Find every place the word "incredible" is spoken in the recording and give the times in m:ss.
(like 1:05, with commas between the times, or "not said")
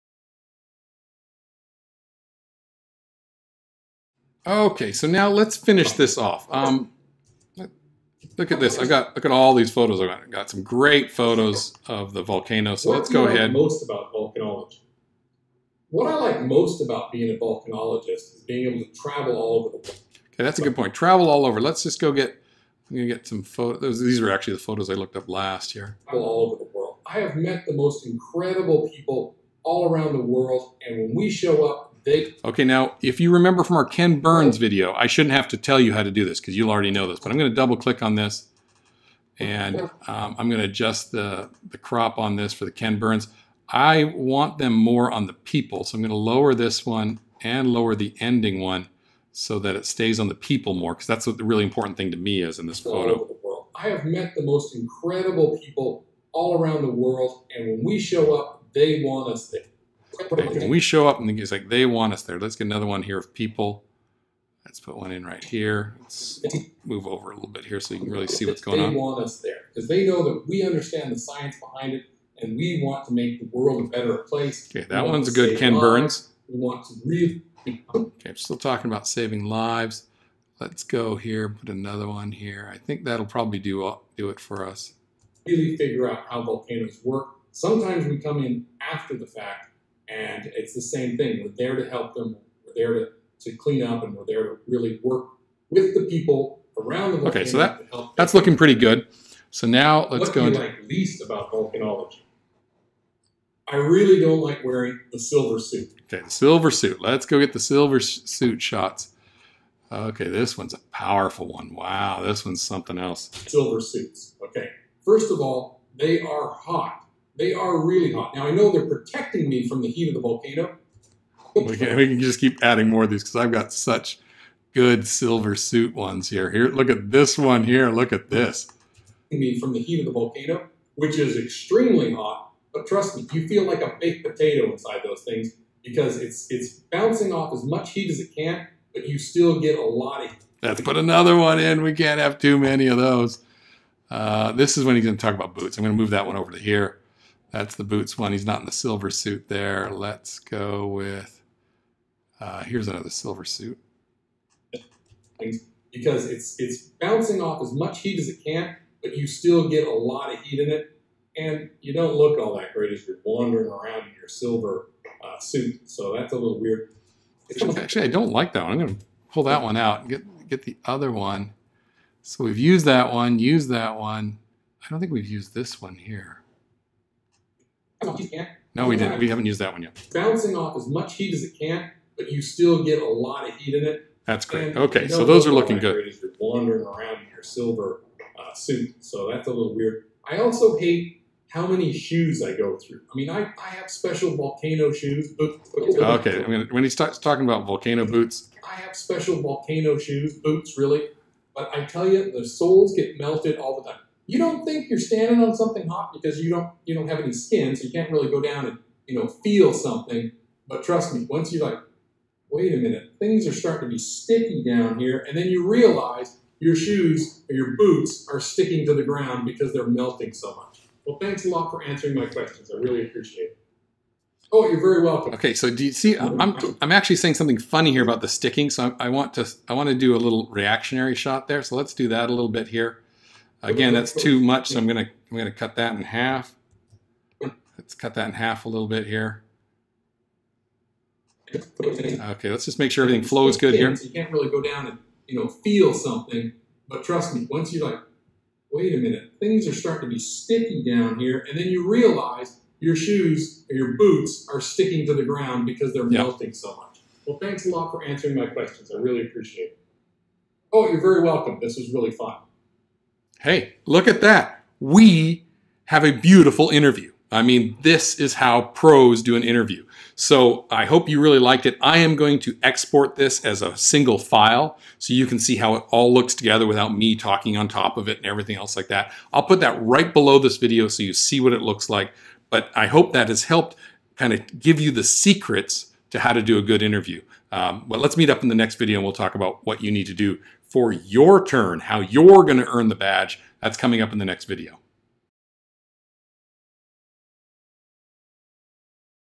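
0:28, 0:54.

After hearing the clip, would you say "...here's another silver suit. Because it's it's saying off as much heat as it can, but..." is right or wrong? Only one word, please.
wrong.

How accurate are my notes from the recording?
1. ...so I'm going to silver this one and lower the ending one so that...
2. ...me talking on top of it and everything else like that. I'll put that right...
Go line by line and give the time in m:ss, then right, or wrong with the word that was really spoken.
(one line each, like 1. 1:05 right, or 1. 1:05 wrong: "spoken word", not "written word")
1. 0:45 wrong: "lower", not "silver"
2. 4:36 right.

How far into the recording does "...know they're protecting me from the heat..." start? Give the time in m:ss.
1:58.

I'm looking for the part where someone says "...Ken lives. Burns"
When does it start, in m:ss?
1:15.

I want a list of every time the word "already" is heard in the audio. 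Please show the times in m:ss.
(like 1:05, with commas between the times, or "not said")
0:36.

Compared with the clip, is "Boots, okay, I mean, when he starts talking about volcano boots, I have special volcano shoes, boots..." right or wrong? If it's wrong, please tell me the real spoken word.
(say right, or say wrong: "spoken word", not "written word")
right.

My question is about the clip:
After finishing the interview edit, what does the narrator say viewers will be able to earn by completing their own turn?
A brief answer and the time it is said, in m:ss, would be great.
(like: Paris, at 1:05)
the badge, at 4:52.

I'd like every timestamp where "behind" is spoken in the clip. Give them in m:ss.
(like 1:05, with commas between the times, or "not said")
1:11.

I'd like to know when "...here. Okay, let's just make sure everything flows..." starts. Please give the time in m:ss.
3:59.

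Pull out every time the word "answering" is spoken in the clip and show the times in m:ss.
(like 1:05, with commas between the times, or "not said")
3:41, 4:18.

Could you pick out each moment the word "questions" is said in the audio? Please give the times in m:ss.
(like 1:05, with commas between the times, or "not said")
3:42, 4:18.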